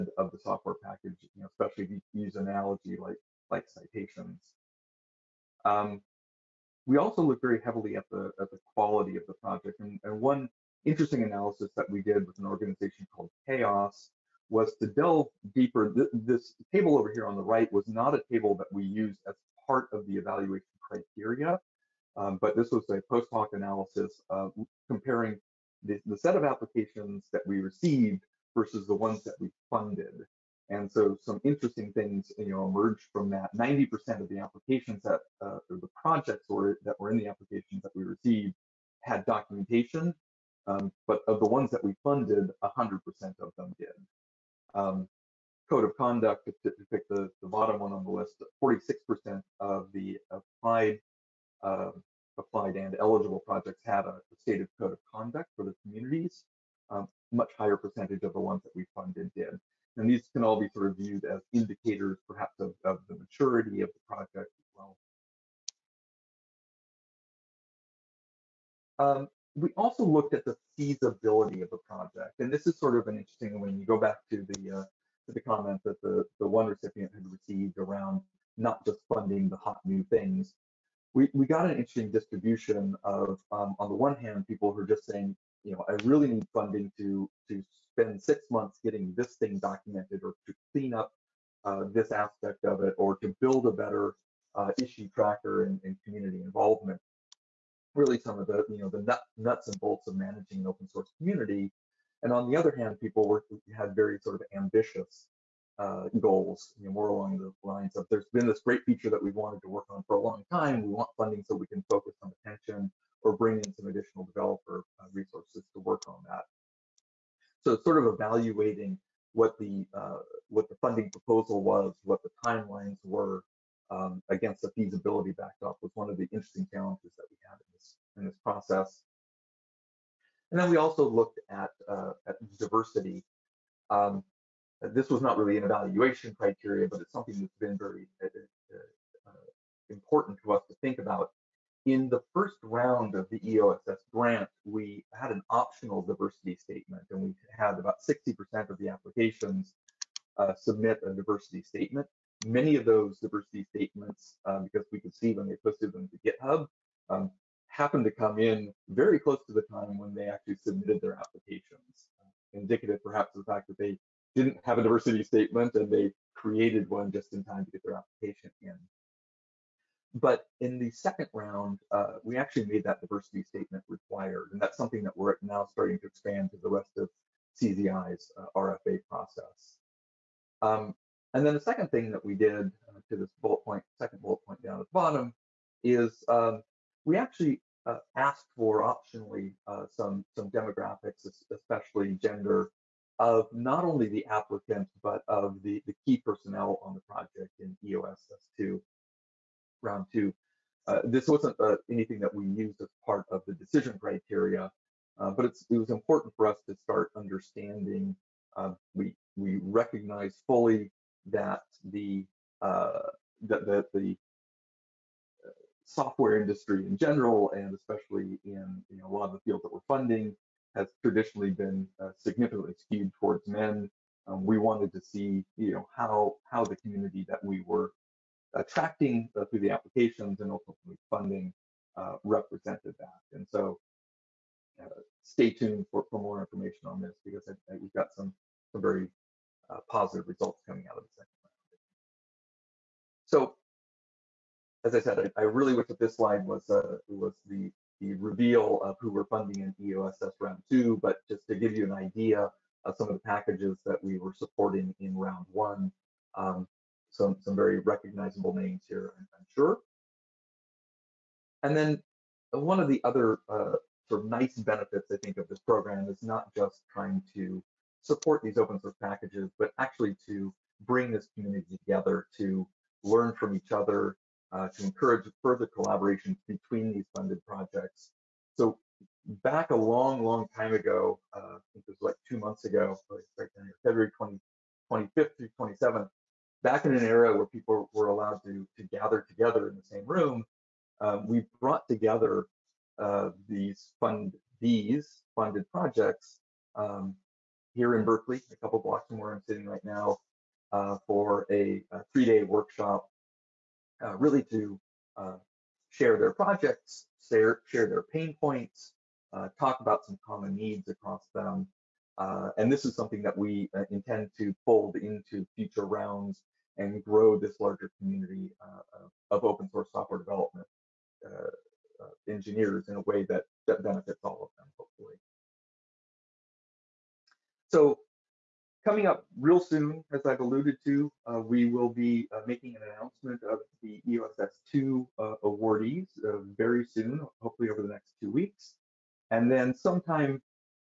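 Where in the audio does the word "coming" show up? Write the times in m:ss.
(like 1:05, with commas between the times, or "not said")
4:00, 5:28.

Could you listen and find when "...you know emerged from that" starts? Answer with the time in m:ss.
0:32.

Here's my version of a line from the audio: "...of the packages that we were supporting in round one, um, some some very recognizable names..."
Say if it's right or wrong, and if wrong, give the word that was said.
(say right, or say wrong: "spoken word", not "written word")
right.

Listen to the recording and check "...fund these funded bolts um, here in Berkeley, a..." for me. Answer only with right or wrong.
wrong.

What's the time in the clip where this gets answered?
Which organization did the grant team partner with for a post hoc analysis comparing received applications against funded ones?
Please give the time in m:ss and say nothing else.
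0:13.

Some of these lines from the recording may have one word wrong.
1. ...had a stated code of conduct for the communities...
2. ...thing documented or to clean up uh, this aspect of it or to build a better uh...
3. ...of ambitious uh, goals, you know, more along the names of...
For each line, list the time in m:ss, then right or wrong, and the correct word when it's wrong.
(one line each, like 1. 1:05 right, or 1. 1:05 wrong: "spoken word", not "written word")
1. 0:53 right
2. 1:29 right
3. 1:44 wrong: "lines", not "names".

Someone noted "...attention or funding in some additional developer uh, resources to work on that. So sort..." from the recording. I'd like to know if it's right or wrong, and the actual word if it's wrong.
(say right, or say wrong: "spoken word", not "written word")
wrong: "bring", not "funding".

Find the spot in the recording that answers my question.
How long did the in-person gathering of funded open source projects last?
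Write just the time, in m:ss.
5:02.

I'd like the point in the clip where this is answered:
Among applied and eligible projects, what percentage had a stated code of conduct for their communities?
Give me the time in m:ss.
0:48.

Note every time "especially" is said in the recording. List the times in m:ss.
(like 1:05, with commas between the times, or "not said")
0:01, 3:11, 3:37.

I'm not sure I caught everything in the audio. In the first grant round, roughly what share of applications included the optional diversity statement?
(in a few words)
60%.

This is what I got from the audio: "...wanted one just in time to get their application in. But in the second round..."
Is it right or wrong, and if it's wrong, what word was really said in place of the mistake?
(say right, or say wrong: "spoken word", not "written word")
wrong: "created", not "wanted".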